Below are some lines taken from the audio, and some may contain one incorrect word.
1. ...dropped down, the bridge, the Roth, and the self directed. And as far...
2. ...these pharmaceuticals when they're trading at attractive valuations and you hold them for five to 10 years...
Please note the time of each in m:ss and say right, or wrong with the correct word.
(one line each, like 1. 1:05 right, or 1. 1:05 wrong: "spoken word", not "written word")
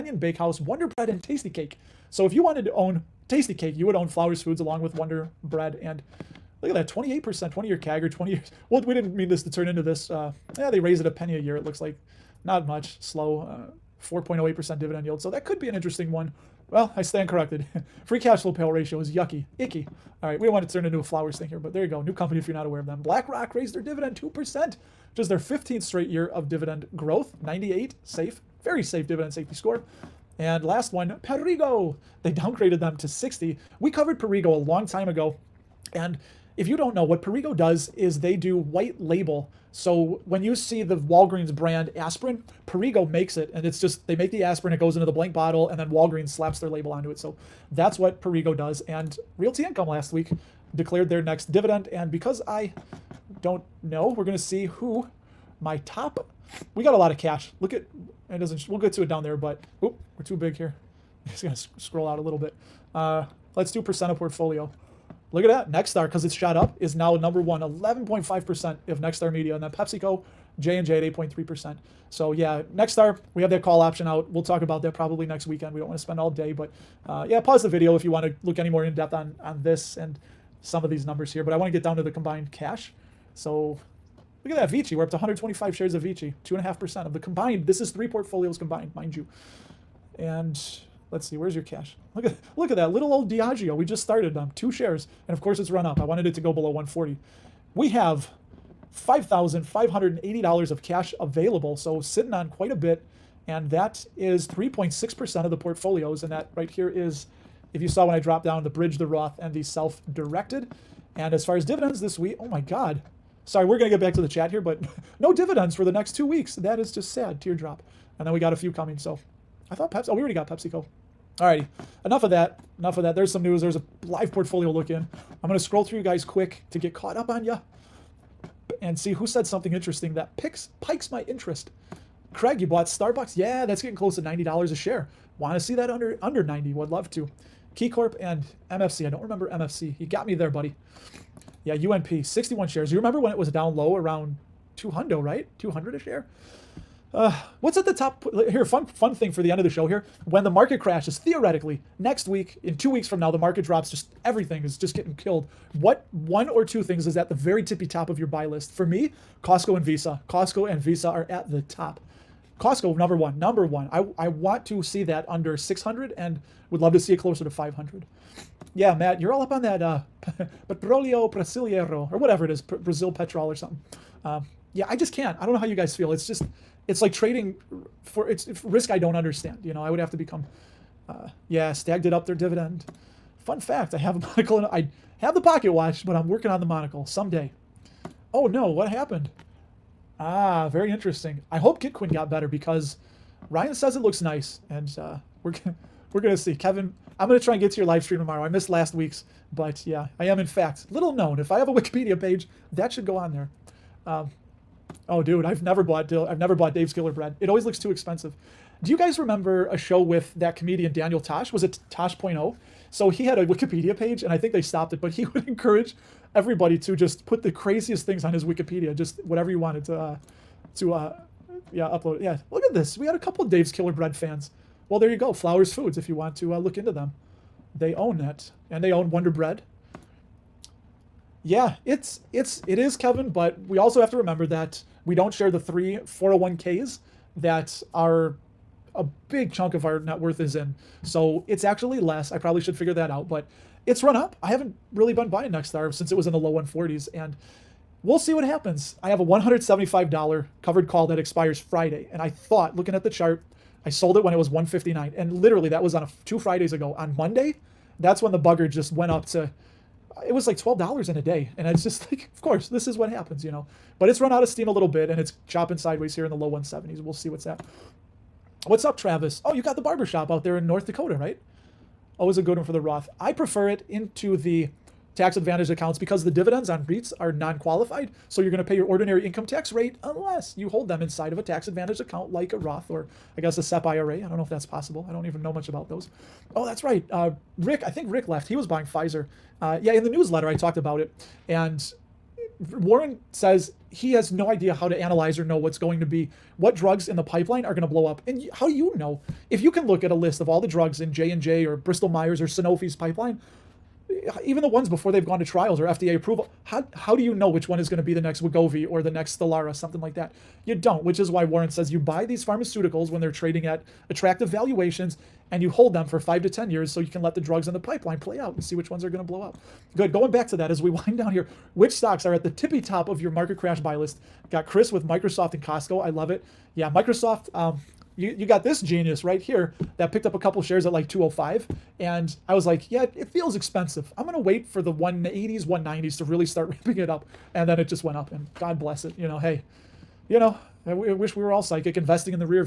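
1. 1:48 right
2. 5:12 right.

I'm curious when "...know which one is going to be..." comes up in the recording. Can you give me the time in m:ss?
5:07.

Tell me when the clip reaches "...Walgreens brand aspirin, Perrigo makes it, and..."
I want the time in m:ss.
0:40.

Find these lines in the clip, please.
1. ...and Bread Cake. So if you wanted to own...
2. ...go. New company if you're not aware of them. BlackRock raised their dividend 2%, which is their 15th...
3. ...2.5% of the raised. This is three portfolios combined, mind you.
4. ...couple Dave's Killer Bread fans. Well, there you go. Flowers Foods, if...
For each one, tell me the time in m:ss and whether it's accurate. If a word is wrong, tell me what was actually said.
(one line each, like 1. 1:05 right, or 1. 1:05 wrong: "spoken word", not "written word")
1. 0:01 wrong: "Tasty", not "Bread"
2. 0:21 right
3. 1:26 wrong: "combined", not "raised"
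4. 3:43 right.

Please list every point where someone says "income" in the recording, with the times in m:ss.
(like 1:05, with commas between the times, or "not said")
0:49, 4:39.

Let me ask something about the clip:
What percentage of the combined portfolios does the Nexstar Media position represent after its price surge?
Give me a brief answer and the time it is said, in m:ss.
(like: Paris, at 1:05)
11.5%, at 1:07.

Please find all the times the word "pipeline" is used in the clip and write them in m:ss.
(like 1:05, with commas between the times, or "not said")
4:57, 5:02, 5:17.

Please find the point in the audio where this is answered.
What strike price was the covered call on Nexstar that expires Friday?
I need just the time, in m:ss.
4:09.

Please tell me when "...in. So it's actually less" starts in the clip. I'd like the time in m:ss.
4:00.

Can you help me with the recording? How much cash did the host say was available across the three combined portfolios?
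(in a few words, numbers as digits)
$5,580.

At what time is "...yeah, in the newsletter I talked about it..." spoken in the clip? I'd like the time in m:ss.
4:49.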